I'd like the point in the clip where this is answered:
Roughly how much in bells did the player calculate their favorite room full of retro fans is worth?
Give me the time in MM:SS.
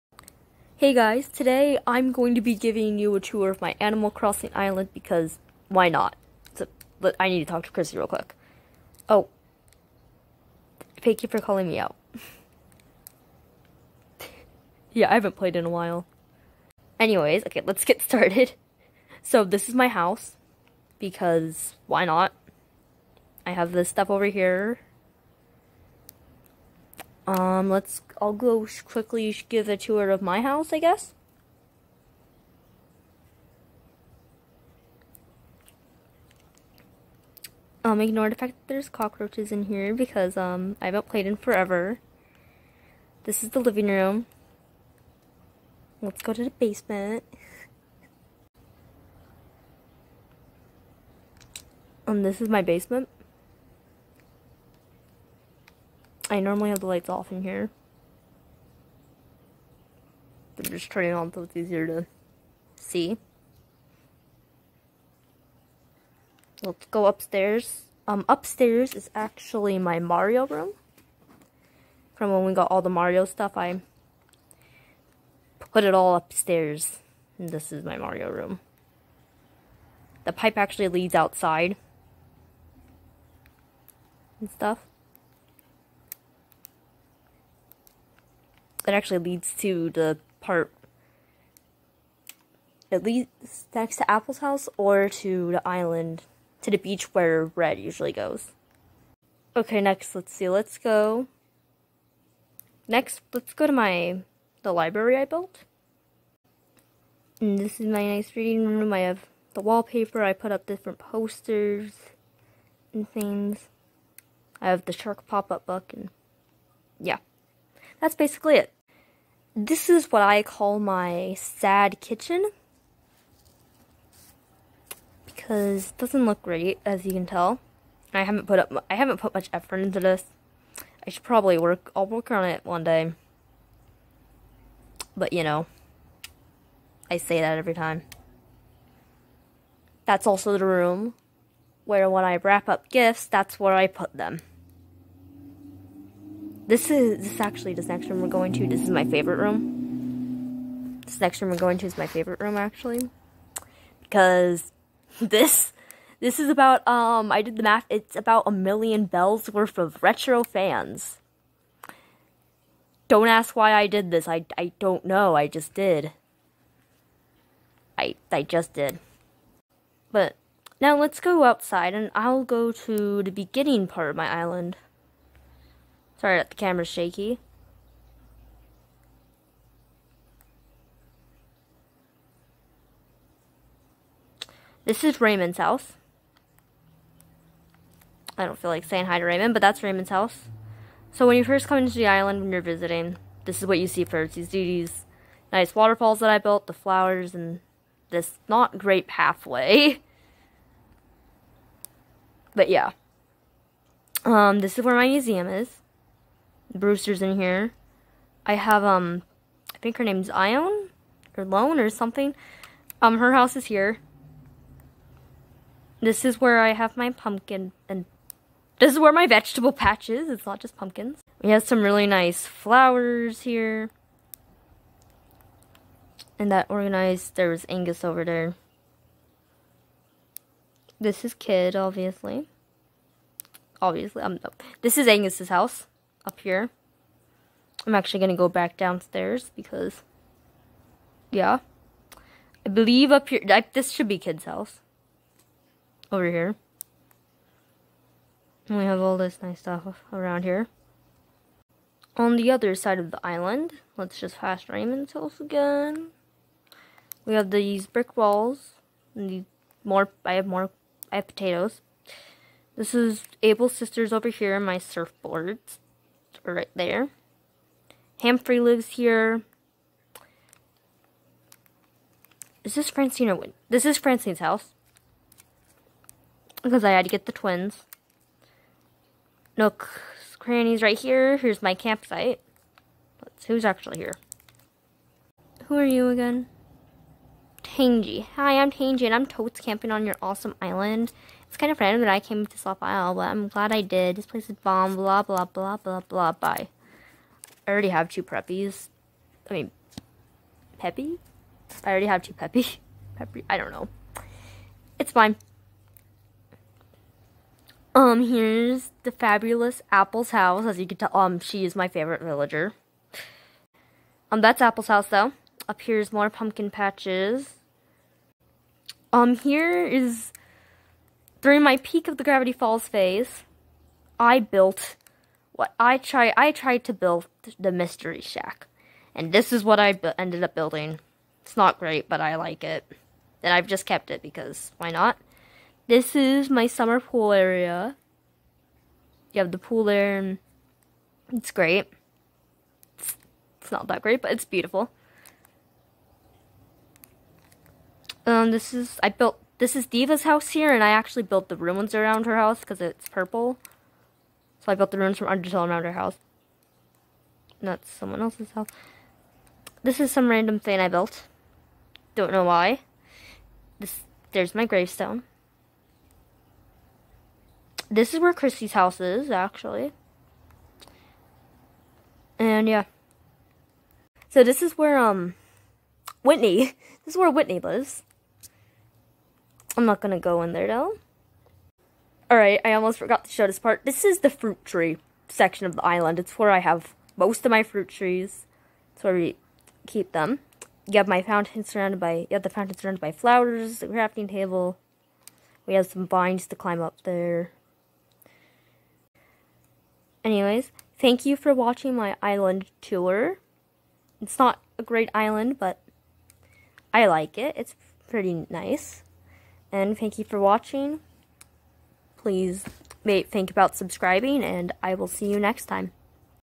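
02:38.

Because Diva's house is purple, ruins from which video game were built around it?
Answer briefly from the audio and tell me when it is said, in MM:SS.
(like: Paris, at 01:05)
Undertale, at 05:55.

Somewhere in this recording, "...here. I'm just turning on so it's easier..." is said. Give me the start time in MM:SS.
00:57.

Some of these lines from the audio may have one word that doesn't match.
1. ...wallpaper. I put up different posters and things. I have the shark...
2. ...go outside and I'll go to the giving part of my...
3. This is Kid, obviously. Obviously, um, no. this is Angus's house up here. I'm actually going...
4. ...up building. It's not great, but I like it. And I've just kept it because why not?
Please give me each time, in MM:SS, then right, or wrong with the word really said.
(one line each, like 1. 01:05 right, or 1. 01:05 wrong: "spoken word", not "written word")
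1. 01:49 right
2. 02:51 wrong: "beginning", not "giving"
3. 03:50 right
4. 05:30 right.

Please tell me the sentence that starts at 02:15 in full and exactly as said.
But you know, I say that every time.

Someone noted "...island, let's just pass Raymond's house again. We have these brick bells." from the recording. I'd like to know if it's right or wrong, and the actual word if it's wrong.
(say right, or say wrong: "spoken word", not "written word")
wrong: "walls", not "bells".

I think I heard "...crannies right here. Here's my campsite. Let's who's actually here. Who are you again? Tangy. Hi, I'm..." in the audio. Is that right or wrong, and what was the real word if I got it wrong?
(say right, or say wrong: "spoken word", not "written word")
right.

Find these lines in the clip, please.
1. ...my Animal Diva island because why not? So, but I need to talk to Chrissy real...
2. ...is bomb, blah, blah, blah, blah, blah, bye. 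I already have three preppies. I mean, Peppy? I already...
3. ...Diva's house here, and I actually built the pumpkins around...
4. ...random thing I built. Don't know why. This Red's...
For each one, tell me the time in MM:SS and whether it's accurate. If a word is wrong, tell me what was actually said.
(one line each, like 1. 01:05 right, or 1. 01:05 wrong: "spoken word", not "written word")
1. 00:03 wrong: "Crossing", not "Diva"
2. 04:54 wrong: "two", not "three"
3. 05:49 wrong: "ruins", not "pumpkins"
4. 06:00 wrong: "There", not "Red".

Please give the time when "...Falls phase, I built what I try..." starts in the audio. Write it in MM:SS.
05:22.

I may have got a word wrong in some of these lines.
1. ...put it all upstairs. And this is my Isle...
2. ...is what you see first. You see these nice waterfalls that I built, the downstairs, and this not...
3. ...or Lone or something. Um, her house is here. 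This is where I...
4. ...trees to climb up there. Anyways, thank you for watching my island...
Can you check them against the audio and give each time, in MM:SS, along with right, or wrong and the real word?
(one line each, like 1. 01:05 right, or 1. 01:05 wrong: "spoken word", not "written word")
1. 01:15 wrong: "Mario", not "Isle"
2. 03:13 wrong: "flowers", not "downstairs"
3. 03:31 right
4. 06:36 wrong: "vines", not "trees".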